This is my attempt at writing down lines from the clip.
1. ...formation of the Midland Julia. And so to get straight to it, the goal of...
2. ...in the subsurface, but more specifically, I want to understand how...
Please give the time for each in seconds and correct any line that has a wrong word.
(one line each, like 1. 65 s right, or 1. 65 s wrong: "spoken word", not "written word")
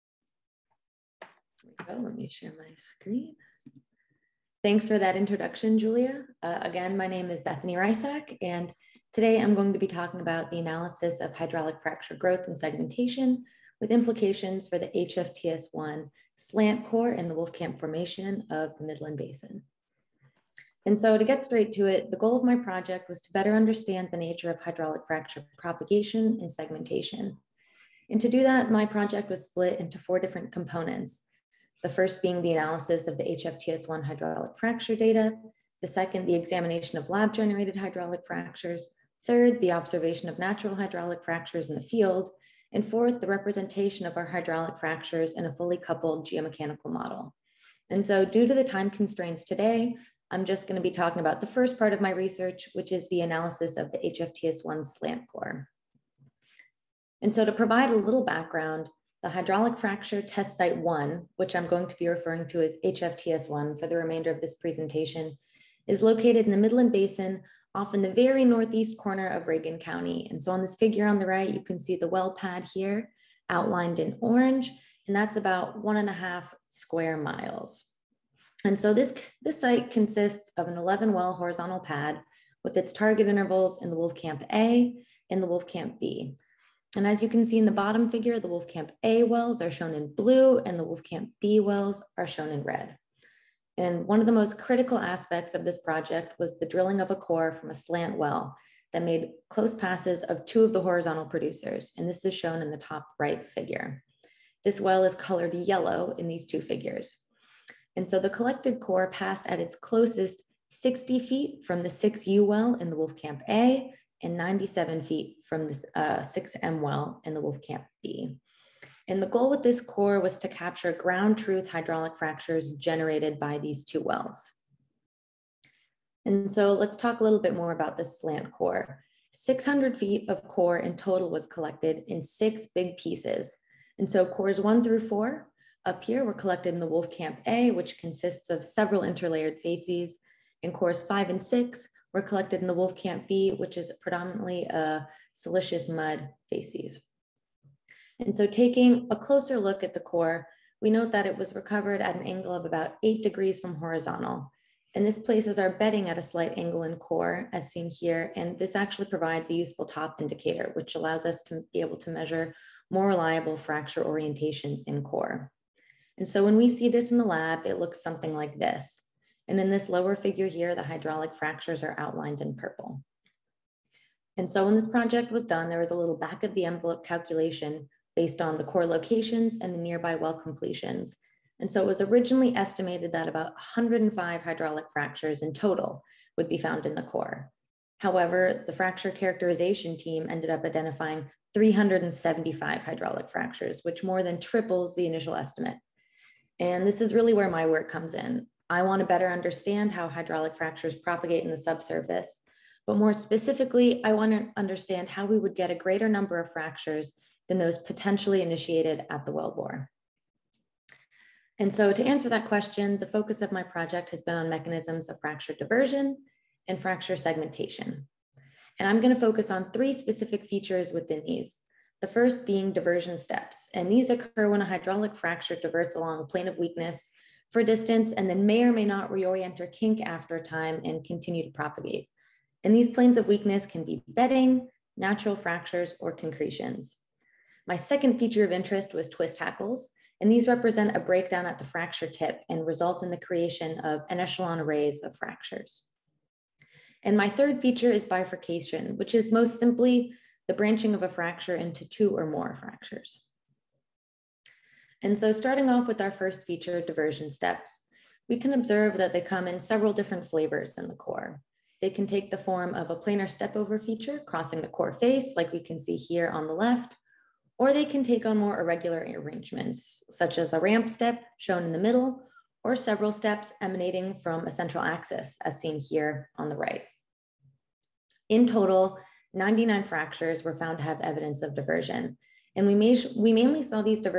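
1. 17 s wrong: "Basin", not "Julia"
2. 201 s right.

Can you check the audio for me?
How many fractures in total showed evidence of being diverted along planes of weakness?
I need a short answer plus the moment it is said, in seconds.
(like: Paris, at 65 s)
99, at 279 s.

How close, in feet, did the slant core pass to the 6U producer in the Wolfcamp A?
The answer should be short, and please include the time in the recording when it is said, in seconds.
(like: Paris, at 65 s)
60 feet, at 110 s.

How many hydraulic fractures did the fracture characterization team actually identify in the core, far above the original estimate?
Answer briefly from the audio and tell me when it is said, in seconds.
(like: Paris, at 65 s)
375, at 191 s.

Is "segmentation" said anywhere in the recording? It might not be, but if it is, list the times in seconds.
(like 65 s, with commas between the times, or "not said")
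12 s, 26 s, 217 s.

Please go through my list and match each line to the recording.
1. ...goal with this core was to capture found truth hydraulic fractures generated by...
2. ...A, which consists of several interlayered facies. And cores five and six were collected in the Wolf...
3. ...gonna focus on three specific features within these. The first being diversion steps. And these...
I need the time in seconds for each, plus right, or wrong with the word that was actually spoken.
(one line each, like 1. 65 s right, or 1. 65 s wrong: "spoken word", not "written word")
1. 119 s wrong: "ground", not "found"
2. 137 s right
3. 218 s right.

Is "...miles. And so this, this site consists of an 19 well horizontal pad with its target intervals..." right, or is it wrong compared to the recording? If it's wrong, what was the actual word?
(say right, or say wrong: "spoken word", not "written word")
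wrong: "11", not "19".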